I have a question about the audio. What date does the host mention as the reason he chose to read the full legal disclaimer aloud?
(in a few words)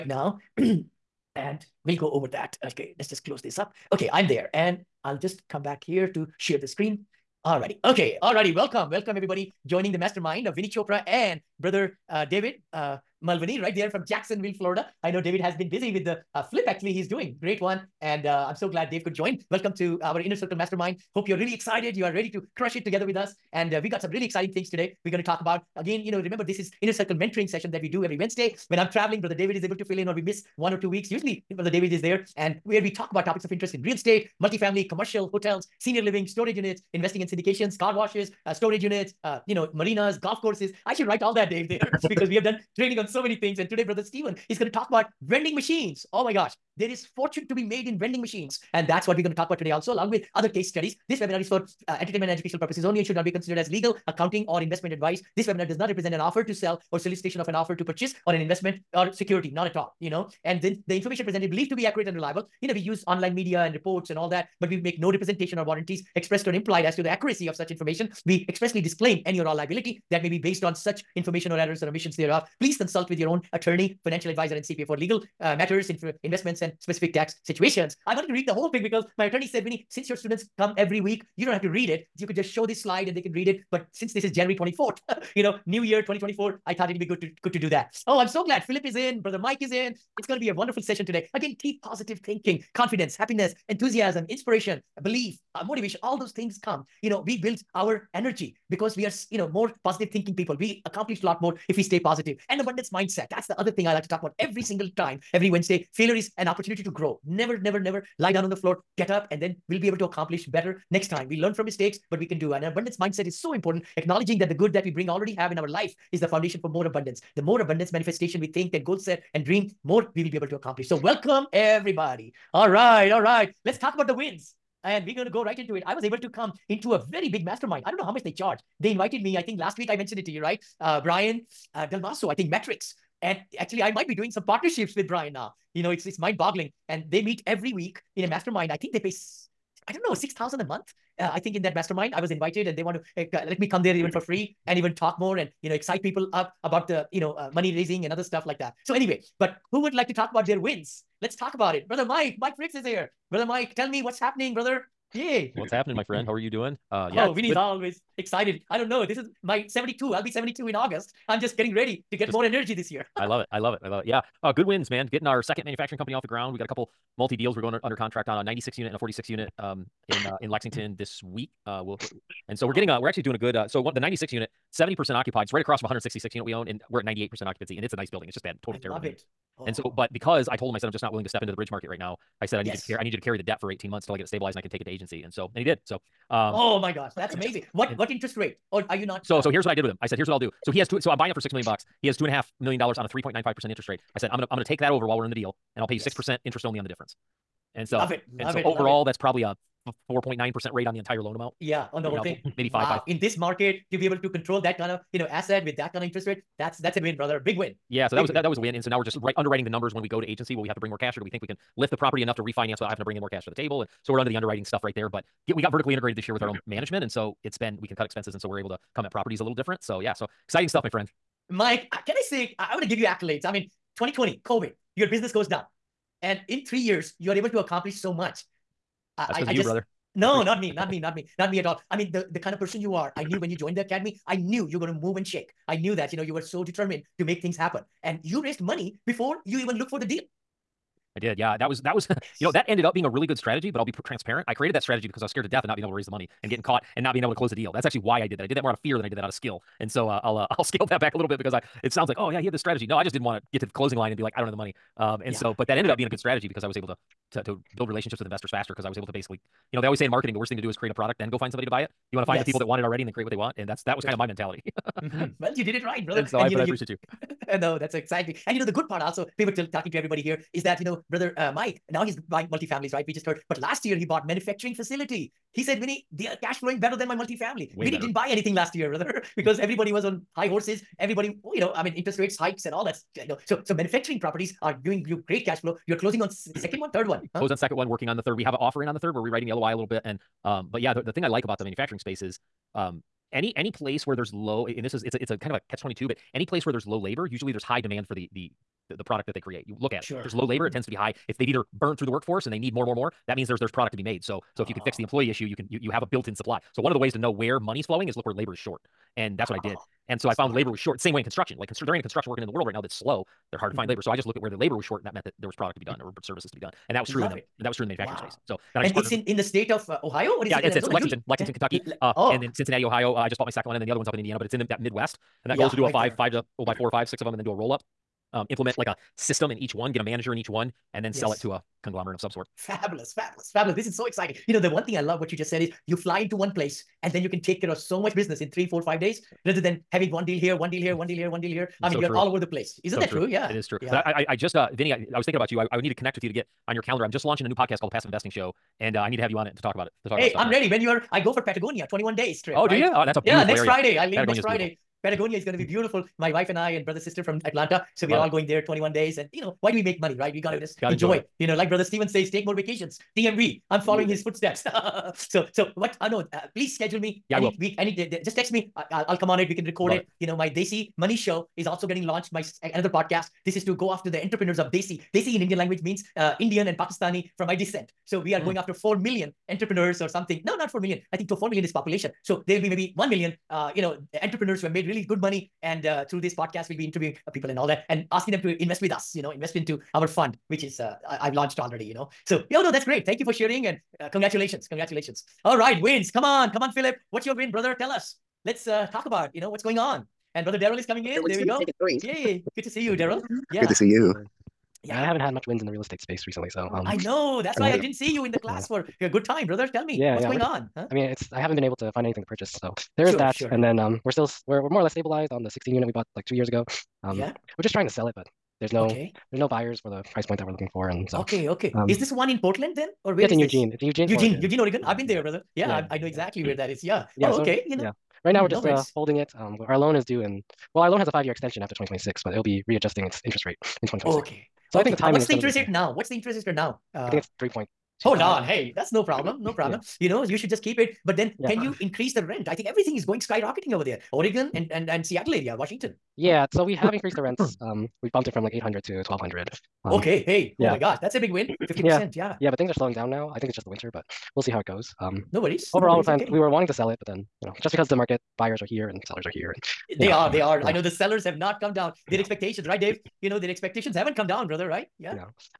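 January 24th.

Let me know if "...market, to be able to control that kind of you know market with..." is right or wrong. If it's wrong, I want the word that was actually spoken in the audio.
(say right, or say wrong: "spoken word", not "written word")
wrong: "asset", not "market".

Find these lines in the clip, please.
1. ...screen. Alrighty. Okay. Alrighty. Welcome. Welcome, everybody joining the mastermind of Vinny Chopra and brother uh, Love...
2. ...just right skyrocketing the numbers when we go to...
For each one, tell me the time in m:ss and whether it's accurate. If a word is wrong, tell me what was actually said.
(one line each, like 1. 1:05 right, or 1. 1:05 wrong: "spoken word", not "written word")
1. 0:06 wrong: "David", not "Love"
2. 3:29 wrong: "underwriting", not "skyrocketing".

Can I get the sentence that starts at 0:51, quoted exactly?
This webinar is for uh, entertainment and educational purposes only.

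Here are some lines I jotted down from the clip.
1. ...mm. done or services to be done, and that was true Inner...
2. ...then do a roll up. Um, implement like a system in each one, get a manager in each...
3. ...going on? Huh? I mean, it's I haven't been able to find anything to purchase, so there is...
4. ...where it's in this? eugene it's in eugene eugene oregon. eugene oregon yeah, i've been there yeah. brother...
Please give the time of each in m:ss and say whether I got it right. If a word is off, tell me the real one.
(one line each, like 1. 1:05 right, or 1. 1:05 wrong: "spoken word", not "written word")
1. 5:15 wrong: "Love", not "Inner"
2. 5:27 right
3. 6:50 right
4. 7:03 right.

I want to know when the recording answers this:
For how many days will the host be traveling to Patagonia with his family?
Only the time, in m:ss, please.
5:51.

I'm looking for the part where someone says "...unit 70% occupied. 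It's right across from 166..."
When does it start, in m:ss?
2:54.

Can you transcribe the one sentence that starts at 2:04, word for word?
And we're going to go right into it.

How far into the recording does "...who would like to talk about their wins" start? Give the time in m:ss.
2:29.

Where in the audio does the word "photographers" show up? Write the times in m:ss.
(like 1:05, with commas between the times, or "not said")
not said.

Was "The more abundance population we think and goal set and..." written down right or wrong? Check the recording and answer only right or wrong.
wrong.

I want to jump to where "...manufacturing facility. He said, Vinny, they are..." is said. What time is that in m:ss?
4:34.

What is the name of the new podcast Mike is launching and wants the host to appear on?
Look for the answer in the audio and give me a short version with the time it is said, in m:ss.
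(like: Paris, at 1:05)
Passive Investing Show, at 5:47.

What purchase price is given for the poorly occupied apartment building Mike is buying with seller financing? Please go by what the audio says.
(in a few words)
6 million.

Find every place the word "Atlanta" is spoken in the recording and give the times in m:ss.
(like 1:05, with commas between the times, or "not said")
5:57.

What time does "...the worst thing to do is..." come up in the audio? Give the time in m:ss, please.
4:20.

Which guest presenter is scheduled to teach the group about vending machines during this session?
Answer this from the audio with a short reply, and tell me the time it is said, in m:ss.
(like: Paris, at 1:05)
Stephen, at 0:43.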